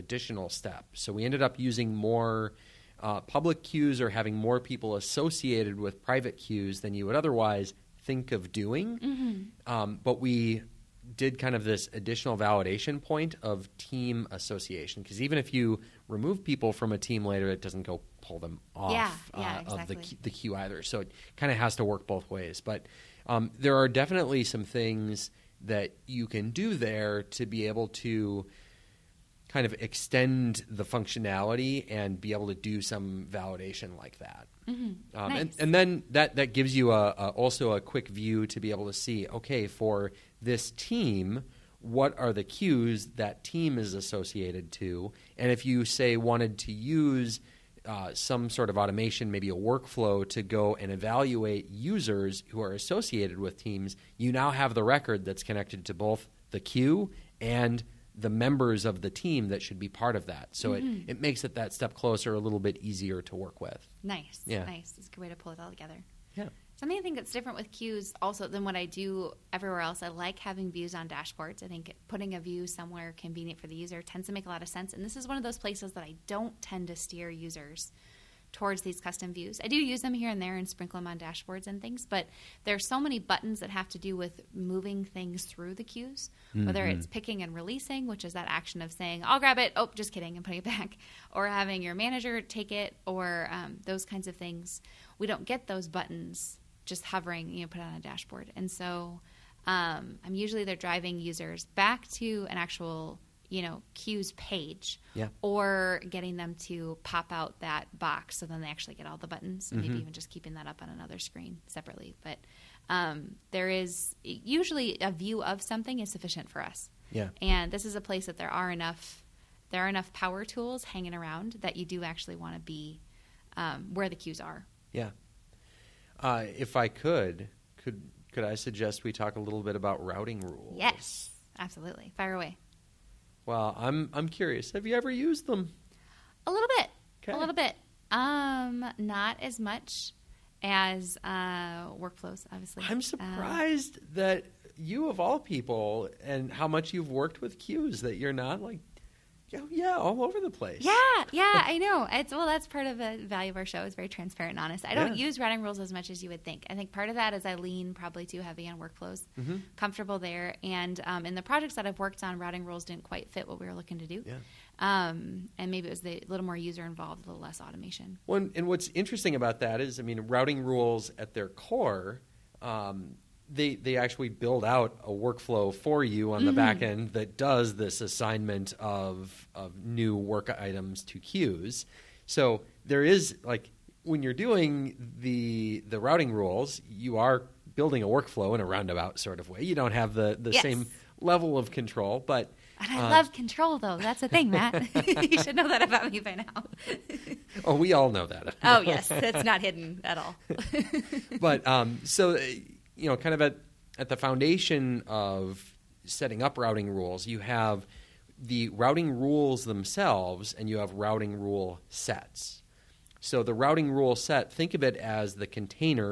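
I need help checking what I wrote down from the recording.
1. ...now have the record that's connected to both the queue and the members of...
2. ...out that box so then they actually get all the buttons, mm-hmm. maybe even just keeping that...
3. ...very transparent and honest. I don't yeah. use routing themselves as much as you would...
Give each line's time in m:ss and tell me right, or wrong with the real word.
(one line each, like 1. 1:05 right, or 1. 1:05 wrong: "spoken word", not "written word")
1. 0:54 right
2. 1:47 right
3. 2:33 wrong: "rules", not "themselves".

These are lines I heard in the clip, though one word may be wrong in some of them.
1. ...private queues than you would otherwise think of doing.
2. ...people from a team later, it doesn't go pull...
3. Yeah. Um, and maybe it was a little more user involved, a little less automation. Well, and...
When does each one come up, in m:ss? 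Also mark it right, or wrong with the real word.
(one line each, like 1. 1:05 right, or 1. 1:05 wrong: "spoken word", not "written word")
1. 0:06 right
2. 0:16 right
3. 2:44 right.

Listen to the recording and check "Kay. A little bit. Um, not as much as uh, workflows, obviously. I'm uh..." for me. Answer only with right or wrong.
right.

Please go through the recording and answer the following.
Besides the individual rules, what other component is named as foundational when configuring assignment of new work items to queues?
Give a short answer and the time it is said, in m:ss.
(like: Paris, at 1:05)
Routing rule sets, at 3:30.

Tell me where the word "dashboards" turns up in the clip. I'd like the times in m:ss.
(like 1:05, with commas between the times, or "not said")
1:11, 1:21, 1:37.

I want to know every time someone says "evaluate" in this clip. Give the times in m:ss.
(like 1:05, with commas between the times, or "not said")
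0:50.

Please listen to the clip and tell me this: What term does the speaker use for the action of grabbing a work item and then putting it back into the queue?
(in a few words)
Releasing.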